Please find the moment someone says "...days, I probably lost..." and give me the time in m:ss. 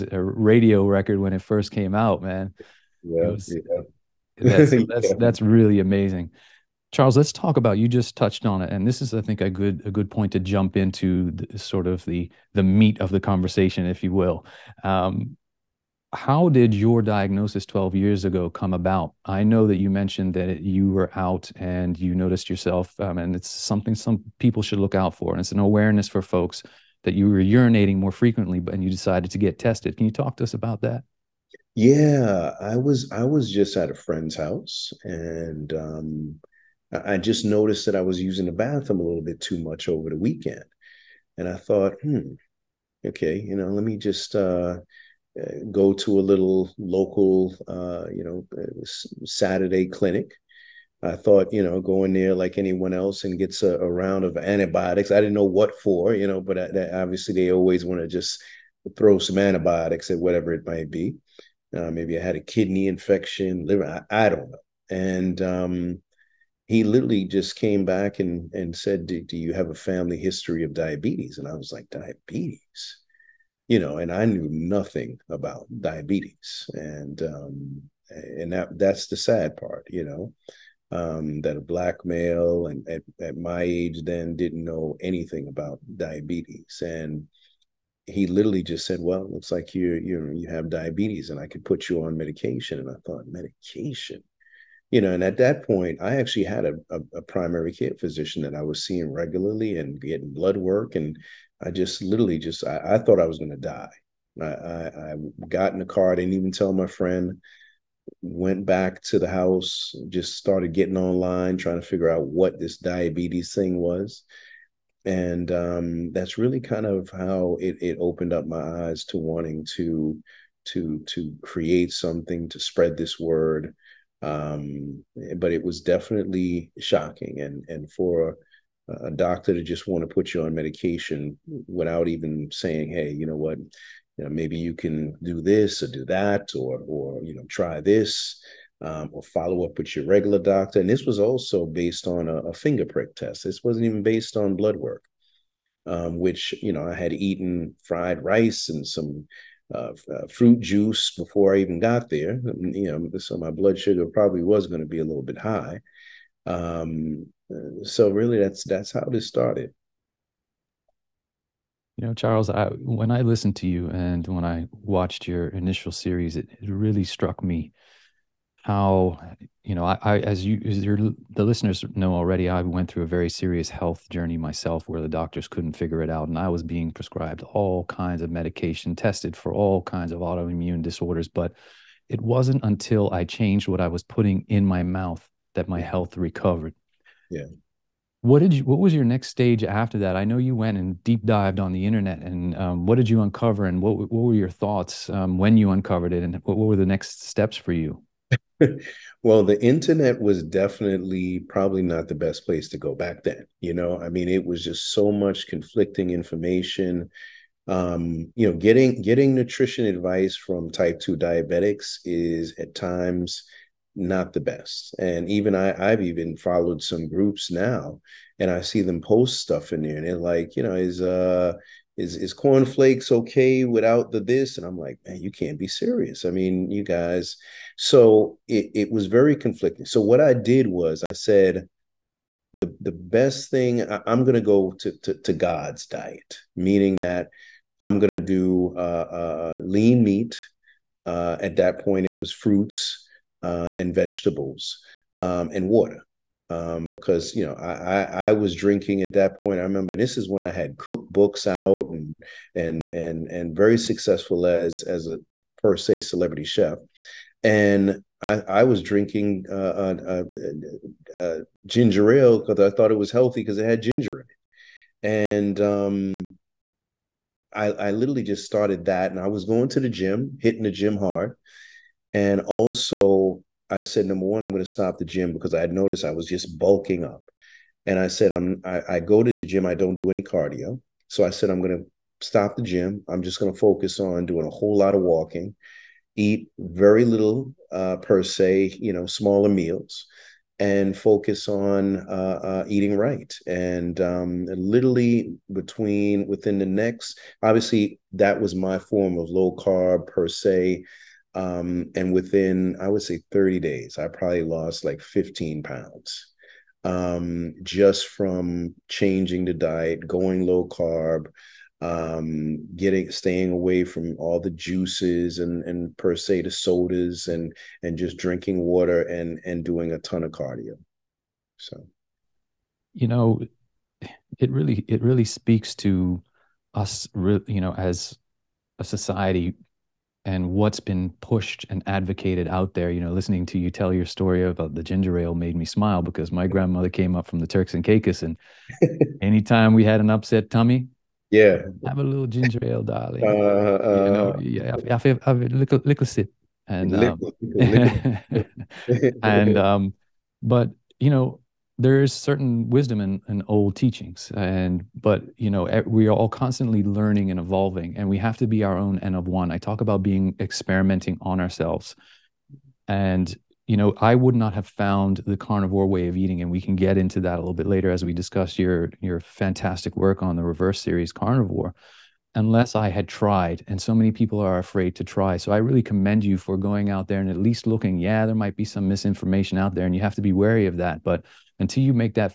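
5:03.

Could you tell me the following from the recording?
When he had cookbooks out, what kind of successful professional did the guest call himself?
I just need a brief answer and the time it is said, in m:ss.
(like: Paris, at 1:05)
celebrity chef, at 4:16.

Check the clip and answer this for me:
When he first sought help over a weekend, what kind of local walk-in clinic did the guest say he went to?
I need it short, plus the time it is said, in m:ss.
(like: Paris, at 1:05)
Saturday clinic, at 0:49.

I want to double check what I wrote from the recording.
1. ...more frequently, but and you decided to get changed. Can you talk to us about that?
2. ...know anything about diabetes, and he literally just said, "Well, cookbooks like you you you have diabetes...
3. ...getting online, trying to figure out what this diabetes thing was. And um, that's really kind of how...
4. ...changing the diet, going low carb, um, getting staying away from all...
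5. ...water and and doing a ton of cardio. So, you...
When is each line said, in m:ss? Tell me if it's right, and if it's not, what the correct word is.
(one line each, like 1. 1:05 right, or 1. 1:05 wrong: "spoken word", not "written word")
1. 0:27 wrong: "tested", not "changed"
2. 1:24 wrong: "looks", not "cookbooks"
3. 1:50 right
4. 5:08 right
5. 5:18 right.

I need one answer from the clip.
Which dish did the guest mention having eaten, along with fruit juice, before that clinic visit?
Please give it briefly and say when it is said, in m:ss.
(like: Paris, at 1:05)
fried rice, at 2:27.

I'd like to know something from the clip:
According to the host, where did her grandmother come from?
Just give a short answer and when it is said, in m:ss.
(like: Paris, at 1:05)
Turks and Caicos, at 5:37.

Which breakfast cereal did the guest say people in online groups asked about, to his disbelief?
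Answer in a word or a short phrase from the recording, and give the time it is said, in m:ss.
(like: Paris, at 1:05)
cornflakes, at 3:42.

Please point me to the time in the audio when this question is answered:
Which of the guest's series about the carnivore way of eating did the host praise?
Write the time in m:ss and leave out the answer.
6:10.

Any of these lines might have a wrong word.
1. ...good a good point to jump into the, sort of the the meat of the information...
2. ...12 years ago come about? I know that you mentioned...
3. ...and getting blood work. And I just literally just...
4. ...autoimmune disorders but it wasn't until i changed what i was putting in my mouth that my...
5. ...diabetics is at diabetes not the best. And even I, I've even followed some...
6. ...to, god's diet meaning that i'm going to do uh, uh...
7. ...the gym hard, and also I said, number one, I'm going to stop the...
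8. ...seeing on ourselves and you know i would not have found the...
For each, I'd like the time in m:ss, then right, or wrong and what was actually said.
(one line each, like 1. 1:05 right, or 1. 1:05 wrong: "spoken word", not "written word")
1. 0:09 wrong: "conversation", not "information"
2. 0:17 right
3. 1:39 right
4. 3:00 right
5. 3:31 wrong: "times", not "diabetes"
6. 3:55 right
7. 4:30 right
8. 6:00 wrong: "experimenting", not "seeing".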